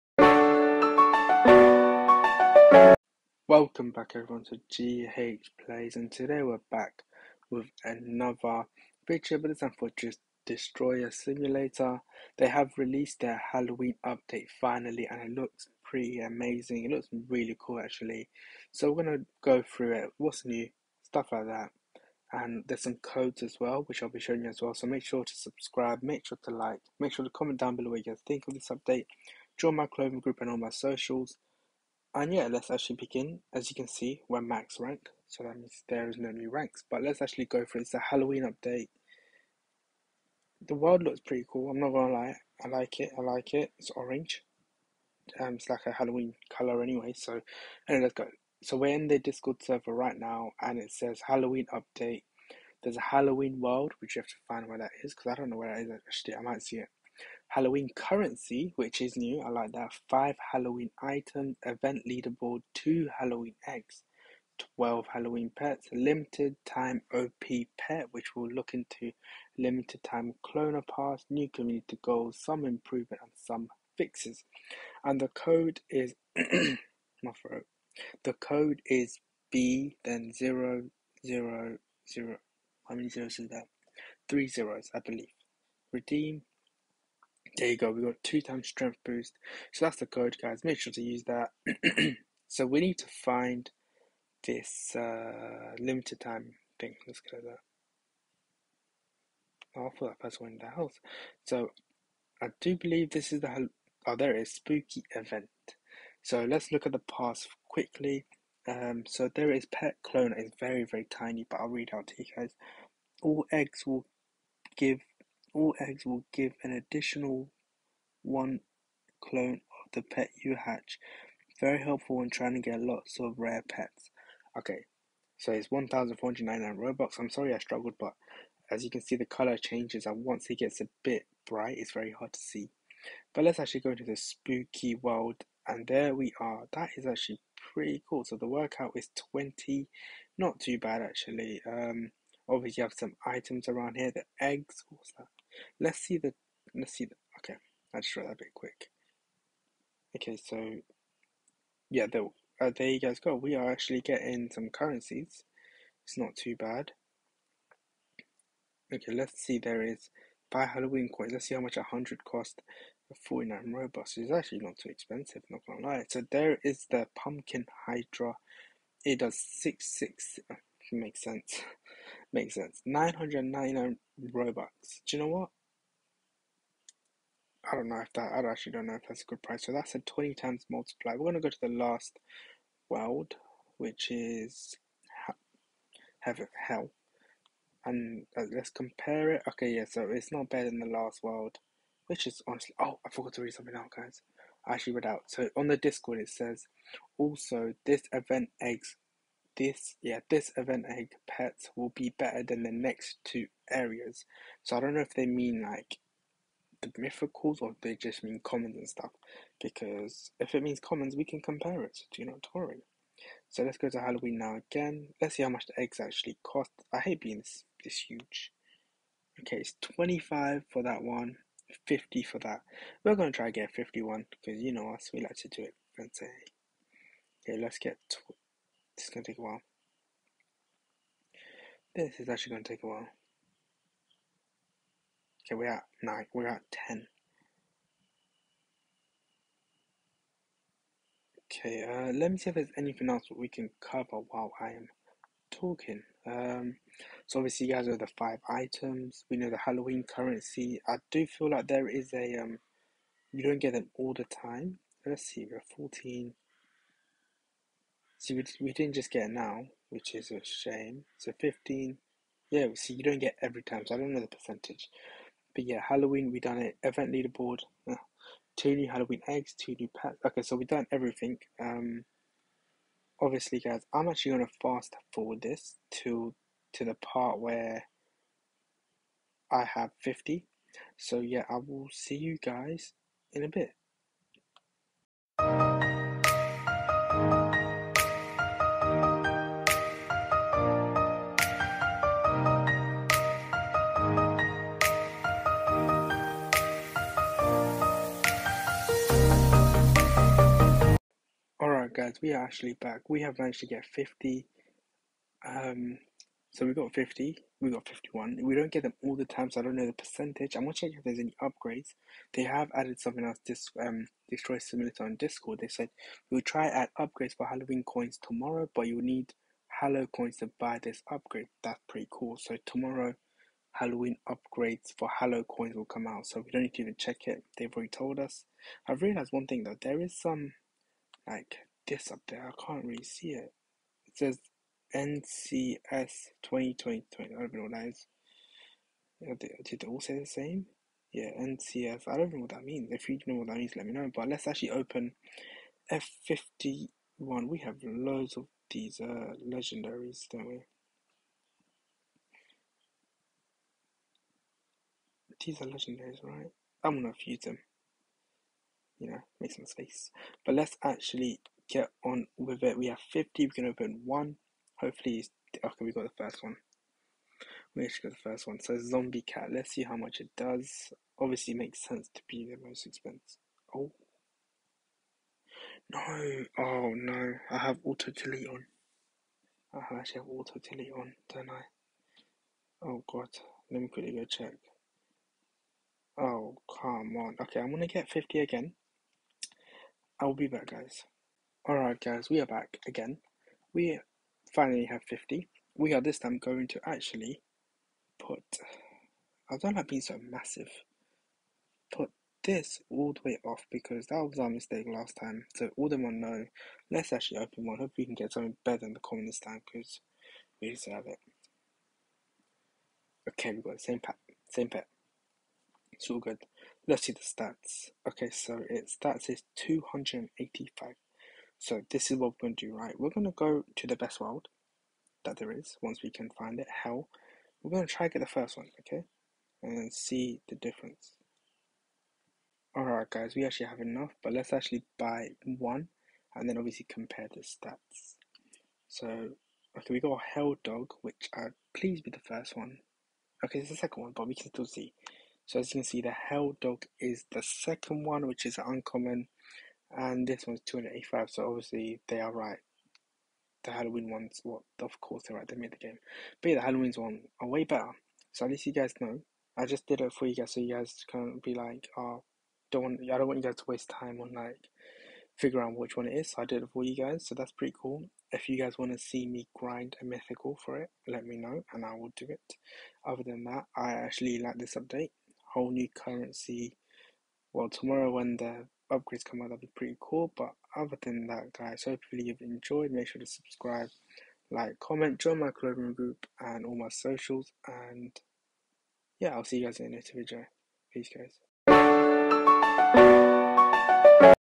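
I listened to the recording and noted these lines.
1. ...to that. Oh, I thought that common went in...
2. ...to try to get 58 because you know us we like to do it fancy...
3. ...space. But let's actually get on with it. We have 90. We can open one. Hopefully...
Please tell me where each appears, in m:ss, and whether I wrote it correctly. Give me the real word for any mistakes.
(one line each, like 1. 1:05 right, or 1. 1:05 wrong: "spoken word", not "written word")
1. 1:37 wrong: "person", not "common"
2. 3:43 wrong: "51", not "58"
3. 5:59 wrong: "50", not "90".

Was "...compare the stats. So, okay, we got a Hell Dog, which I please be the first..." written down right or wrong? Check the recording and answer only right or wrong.
right.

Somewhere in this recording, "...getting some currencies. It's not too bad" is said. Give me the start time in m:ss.
2:34.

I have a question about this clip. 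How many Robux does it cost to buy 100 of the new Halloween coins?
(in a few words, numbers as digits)
49.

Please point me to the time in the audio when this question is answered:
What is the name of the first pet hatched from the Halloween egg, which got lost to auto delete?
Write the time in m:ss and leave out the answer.
6:08.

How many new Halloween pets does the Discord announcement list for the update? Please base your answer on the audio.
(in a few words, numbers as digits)
12.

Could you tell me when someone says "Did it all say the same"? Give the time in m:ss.
5:39.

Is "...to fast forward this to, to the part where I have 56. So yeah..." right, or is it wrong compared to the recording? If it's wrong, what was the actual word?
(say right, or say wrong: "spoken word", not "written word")
wrong: "50", not "56".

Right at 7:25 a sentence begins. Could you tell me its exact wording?
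So as you can see, the Hell Dog is the second one, which is uncommon and this one's 285.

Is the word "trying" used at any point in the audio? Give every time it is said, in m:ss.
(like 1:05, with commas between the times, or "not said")
2:02.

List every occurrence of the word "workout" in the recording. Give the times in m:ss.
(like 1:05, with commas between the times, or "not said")
2:18.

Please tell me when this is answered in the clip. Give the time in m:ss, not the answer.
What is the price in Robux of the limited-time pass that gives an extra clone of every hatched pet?
2:05.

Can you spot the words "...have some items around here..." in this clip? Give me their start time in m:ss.
2:22.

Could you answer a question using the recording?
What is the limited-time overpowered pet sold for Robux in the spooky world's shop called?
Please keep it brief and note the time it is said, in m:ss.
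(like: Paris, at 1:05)
Pumpkin Hydra, at 2:47.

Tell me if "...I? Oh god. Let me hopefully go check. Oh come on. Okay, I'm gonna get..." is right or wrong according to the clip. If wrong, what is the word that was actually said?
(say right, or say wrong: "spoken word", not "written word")
wrong: "quickly", not "hopefully".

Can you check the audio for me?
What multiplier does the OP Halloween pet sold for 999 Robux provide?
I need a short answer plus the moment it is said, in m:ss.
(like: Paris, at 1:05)
20 times, at 2:59.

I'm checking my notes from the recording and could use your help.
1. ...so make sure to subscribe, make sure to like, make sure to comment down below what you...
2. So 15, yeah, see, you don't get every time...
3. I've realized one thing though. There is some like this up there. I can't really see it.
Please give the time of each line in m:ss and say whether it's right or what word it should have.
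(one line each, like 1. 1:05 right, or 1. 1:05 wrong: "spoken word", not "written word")
1. 0:24 right
2. 4:21 right
3. 5:28 right.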